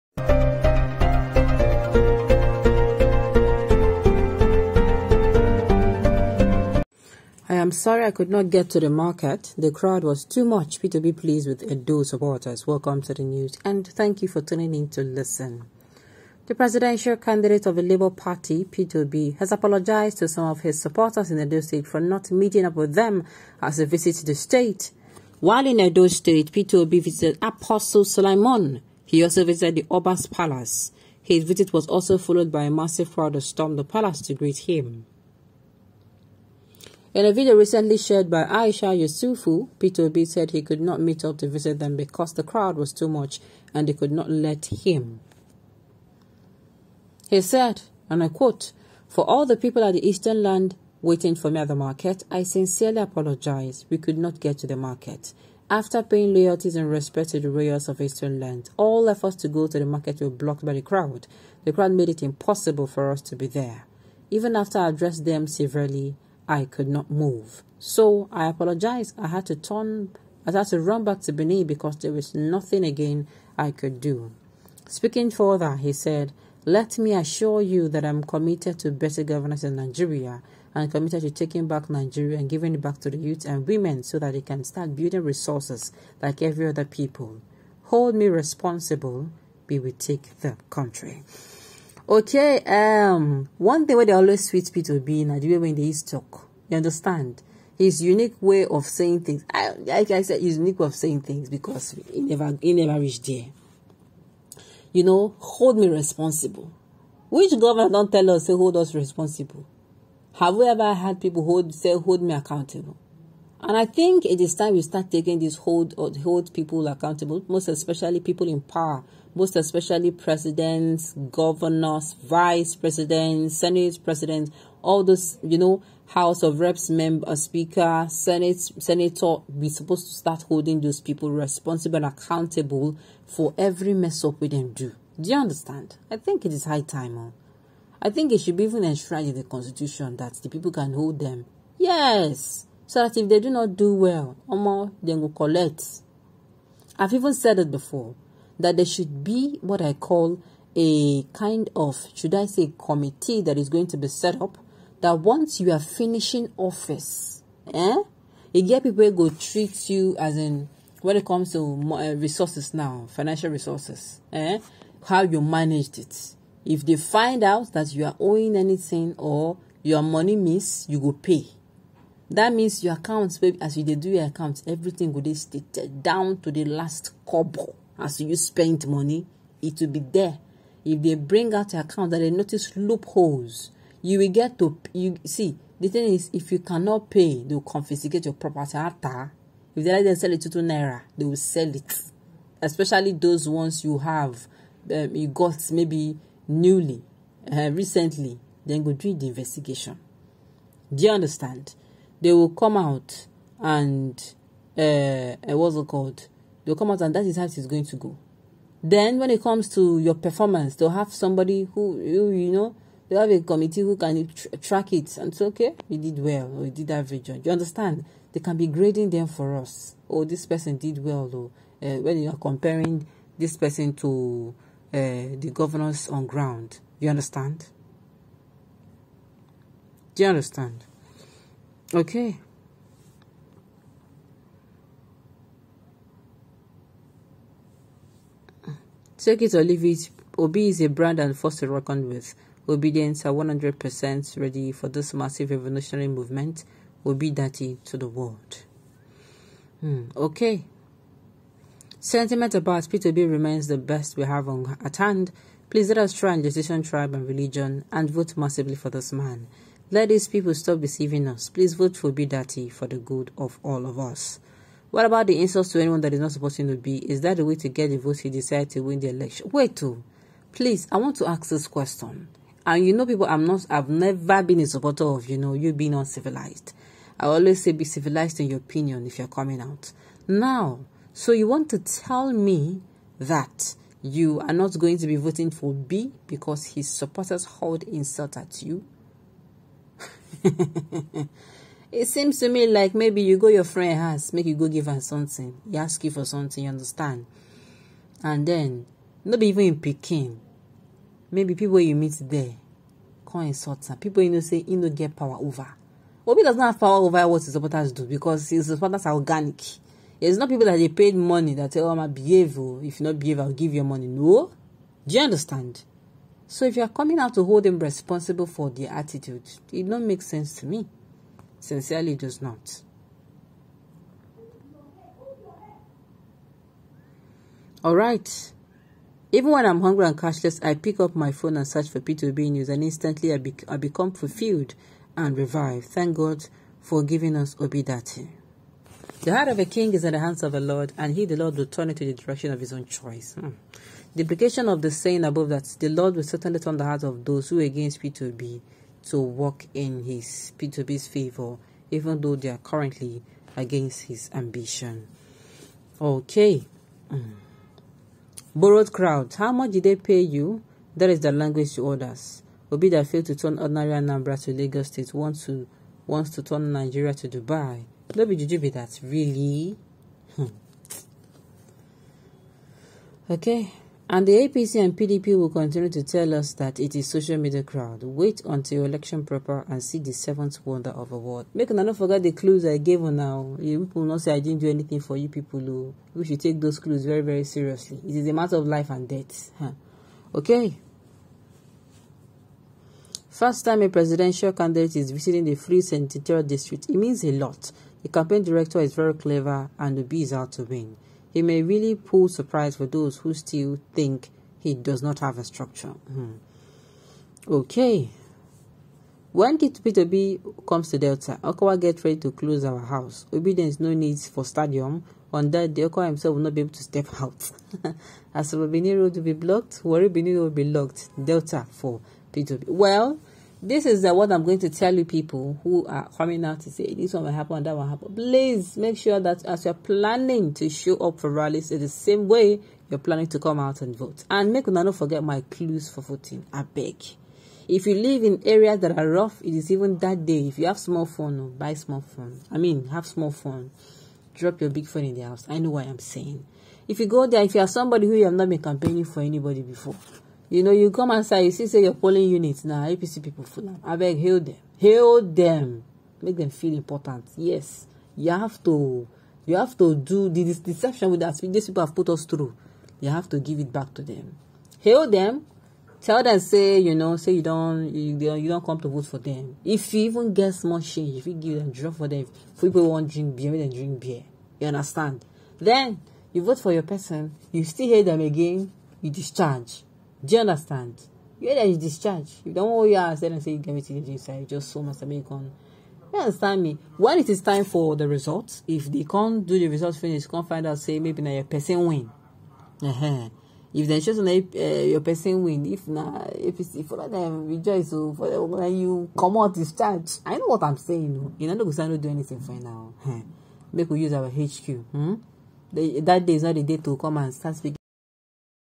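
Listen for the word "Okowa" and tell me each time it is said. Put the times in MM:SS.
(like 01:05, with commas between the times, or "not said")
06:51, 06:55.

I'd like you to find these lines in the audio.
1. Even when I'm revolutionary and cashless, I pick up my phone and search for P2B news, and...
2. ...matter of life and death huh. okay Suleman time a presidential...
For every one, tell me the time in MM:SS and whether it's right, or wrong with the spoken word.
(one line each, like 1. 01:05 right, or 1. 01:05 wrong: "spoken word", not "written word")
1. 05:29 wrong: "hungry", not "revolutionary"
2. 06:28 wrong: "First", not "Suleman".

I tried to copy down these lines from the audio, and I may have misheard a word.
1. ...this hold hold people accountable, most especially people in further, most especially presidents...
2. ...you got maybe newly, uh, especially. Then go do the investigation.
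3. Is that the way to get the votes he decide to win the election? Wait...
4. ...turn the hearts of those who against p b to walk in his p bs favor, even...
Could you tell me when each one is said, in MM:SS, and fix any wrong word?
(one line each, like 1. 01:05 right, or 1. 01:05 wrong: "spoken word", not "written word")
1. 01:55 wrong: "power", not "further"
2. 03:15 wrong: "recently", not "especially"
3. 04:26 right
4. 05:46 right.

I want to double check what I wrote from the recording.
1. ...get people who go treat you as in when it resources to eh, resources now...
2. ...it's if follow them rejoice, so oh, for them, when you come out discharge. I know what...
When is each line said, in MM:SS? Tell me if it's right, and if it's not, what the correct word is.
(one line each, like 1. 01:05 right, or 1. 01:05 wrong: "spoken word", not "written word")
1. 02:38 wrong: "comes", not "resources"
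2. 08:16 right.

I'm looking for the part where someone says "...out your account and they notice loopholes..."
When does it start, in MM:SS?
03:01.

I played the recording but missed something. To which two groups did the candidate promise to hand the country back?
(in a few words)
youth and women.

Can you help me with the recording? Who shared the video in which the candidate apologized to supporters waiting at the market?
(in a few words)
Aisha Yusufu.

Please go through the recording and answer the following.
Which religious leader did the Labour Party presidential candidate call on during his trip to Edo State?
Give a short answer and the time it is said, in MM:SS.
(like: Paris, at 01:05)
Apostle Suleman, at 00:27.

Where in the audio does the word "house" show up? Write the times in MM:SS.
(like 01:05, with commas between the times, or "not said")
02:06, 04:53, 06:52, 07:25.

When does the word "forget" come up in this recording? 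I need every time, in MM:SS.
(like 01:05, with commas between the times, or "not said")
06:21, 07:14.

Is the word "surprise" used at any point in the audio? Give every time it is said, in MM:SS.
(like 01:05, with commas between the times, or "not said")
06:42.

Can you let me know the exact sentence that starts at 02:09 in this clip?
We're supposed to start holding those people responsible and accountable for every mess up we them do.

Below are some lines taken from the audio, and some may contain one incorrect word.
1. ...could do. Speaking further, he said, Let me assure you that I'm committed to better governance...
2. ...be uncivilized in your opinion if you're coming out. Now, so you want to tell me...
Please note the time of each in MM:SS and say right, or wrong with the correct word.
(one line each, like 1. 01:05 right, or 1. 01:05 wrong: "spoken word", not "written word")
1. 01:13 right
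2. 04:37 wrong: "civilized", not "uncivilized".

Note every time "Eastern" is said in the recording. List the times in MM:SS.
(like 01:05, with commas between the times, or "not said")
00:50, 00:57.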